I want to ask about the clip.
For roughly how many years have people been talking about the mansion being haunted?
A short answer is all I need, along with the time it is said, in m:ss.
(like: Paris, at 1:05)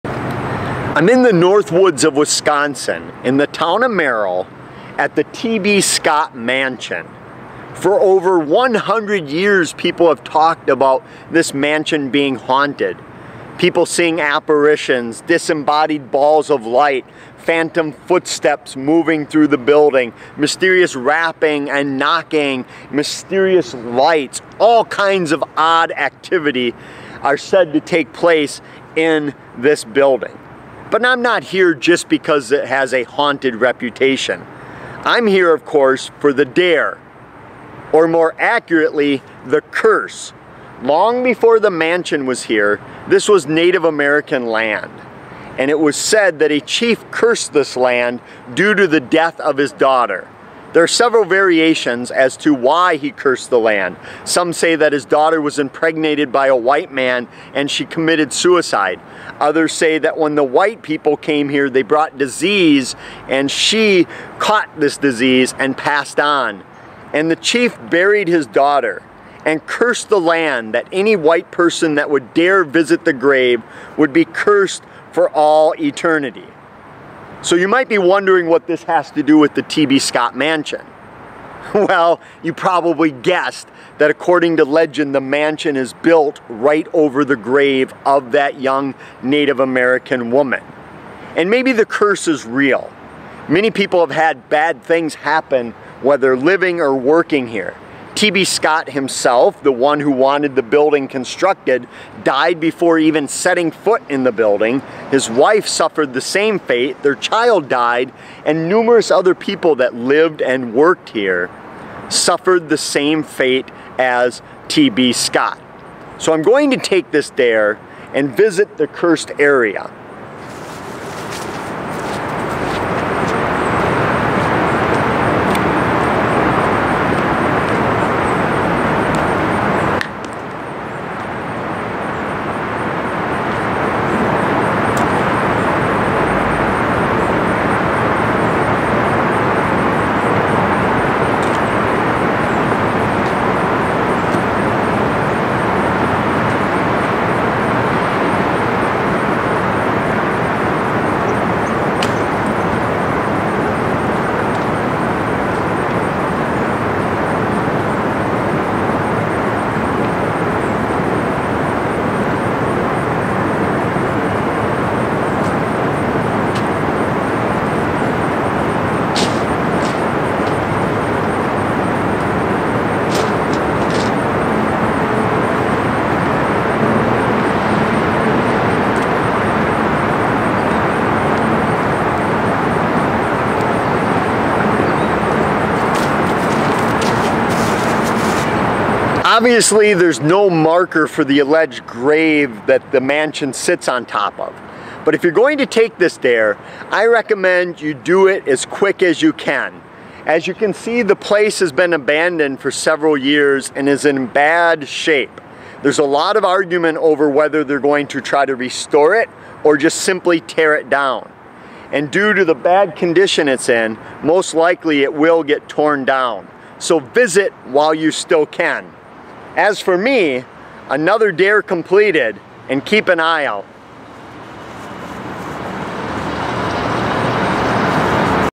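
over 100 years, at 0:07.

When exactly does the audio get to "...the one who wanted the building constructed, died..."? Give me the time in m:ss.
1:39.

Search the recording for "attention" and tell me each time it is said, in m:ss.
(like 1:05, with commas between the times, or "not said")
not said.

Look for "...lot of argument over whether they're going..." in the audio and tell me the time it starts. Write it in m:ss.
3:26.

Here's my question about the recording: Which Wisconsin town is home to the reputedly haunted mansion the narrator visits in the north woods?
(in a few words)
Merrill.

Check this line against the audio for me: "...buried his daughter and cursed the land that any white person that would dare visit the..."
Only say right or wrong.
right.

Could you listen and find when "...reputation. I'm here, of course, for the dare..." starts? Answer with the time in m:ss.
0:33.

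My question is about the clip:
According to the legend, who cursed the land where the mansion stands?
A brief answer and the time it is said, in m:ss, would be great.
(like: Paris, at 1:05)
a chief, at 0:46.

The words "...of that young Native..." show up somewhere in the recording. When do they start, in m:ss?
1:28.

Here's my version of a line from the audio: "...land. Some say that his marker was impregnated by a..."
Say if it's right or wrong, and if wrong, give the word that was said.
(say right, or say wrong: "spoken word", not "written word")
wrong: "daughter", not "marker".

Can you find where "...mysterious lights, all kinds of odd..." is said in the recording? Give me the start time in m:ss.
0:22.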